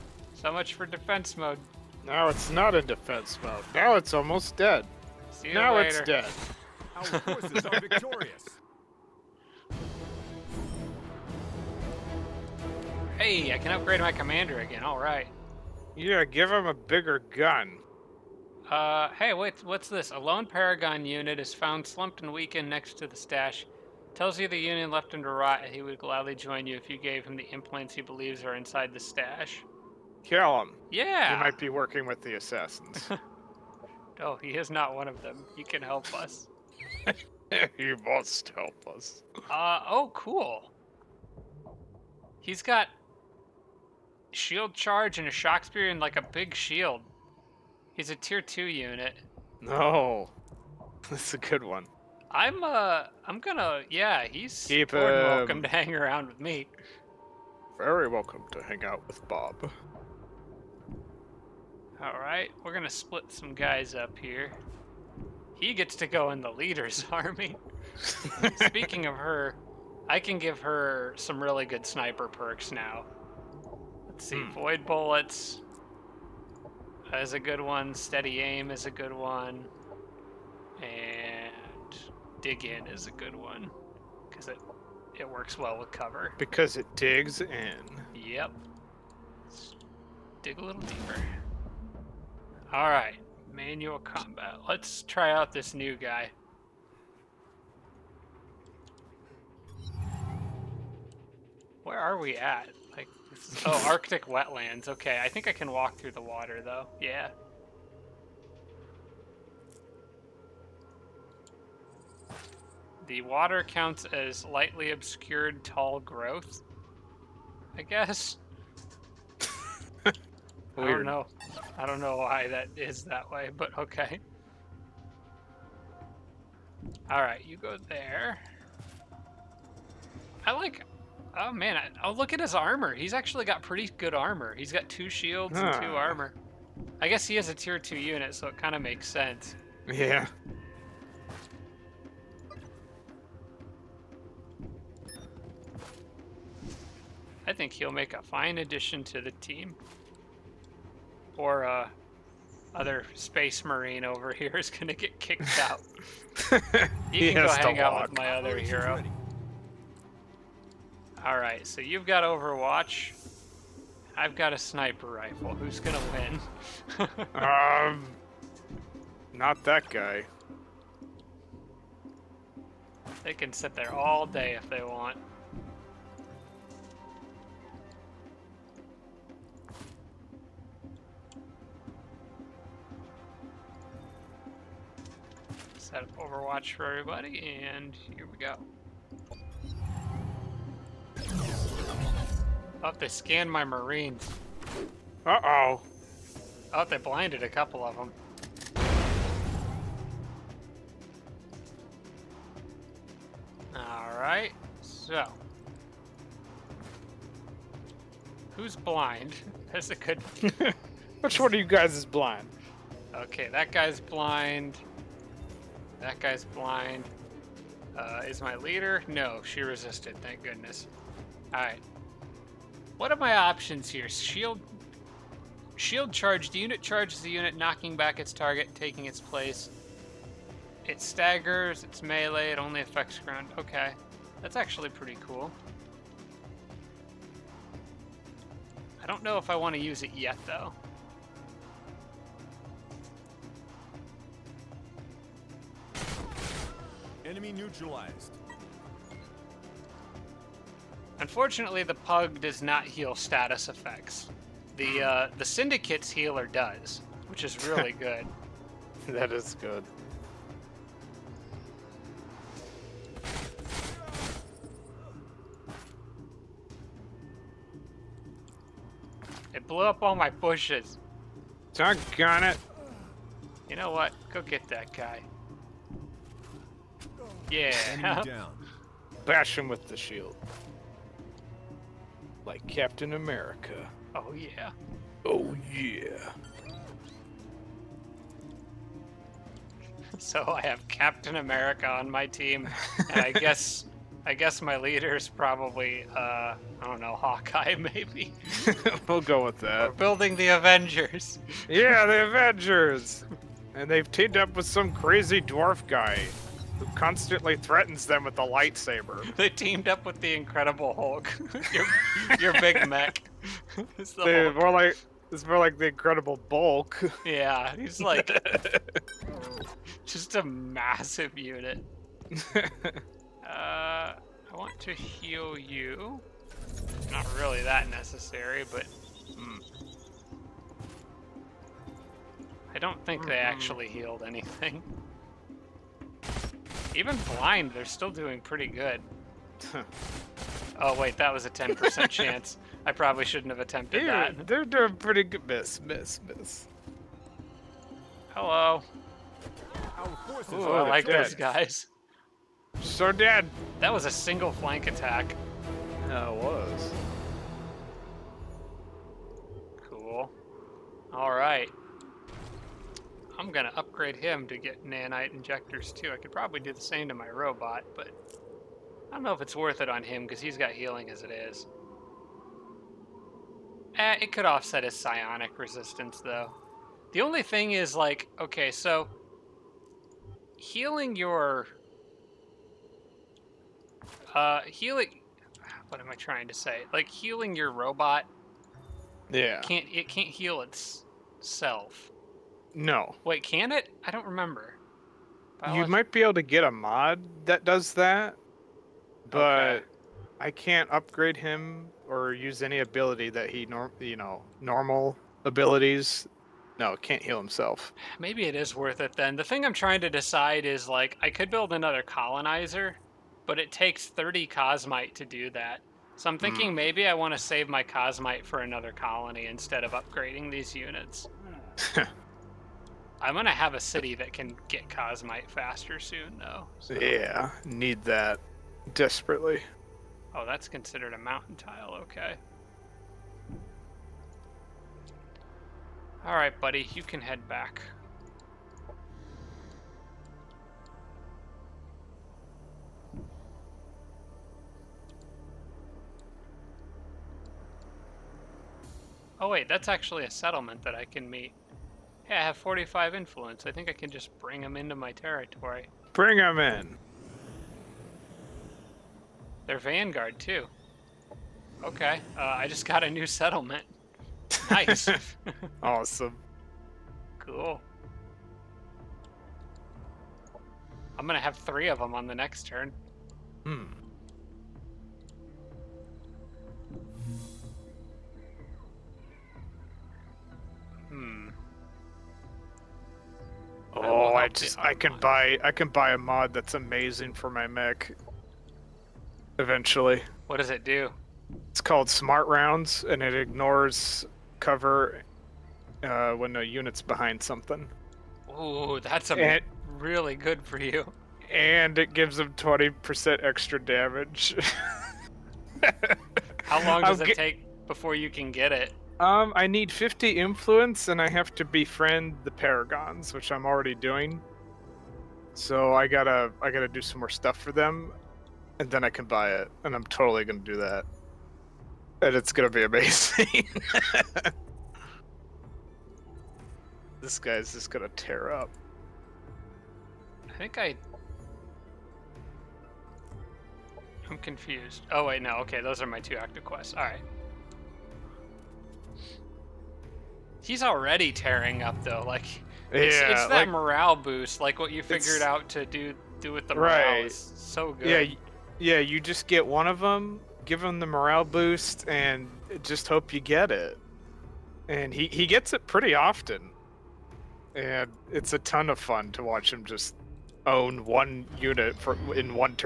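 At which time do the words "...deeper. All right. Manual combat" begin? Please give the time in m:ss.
1:30.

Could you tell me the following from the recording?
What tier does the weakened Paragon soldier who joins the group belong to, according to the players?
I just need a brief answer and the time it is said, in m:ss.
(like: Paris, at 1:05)
tier 2, at 0:48.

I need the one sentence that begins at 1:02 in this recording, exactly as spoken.
All right, we're gonna split some guys up here.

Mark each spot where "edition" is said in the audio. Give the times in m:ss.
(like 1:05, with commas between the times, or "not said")
not said.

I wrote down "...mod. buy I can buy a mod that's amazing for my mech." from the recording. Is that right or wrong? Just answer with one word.
right.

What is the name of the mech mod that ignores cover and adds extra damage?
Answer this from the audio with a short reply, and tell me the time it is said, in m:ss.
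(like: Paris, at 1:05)
Smart Rounds, at 8:12.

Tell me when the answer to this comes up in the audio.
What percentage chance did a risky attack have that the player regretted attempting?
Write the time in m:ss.
5:41.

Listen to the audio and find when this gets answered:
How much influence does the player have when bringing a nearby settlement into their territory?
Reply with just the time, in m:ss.
7:32.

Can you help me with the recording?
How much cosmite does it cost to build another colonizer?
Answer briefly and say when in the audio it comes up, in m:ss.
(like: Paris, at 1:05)
30, at 6:54.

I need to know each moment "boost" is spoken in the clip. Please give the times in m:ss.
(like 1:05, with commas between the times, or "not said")
9:04, 9:11.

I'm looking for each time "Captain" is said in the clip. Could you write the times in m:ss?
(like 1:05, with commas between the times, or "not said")
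4:42, 4:50.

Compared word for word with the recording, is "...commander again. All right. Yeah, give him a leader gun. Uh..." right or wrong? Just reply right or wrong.
wrong.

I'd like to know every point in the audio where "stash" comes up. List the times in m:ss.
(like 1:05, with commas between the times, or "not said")
0:23, 0:28.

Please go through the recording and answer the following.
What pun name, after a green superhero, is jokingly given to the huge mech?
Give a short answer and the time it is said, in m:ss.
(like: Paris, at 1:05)
Incredible Bulk, at 5:15.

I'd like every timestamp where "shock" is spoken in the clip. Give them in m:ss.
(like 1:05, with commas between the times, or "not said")
0:45.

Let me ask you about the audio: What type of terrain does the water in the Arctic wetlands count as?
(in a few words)
lightly obscured tall growth.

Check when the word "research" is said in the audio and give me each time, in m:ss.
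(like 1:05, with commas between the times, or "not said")
not said.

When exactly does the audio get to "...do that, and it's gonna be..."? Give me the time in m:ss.
8:40.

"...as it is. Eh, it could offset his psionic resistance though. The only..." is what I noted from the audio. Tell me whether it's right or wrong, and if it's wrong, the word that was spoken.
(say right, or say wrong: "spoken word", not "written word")
right.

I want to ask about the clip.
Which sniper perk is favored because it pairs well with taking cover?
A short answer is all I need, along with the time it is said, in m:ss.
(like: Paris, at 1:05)
dig in, at 1:22.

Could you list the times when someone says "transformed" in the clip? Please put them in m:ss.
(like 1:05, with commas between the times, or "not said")
not said.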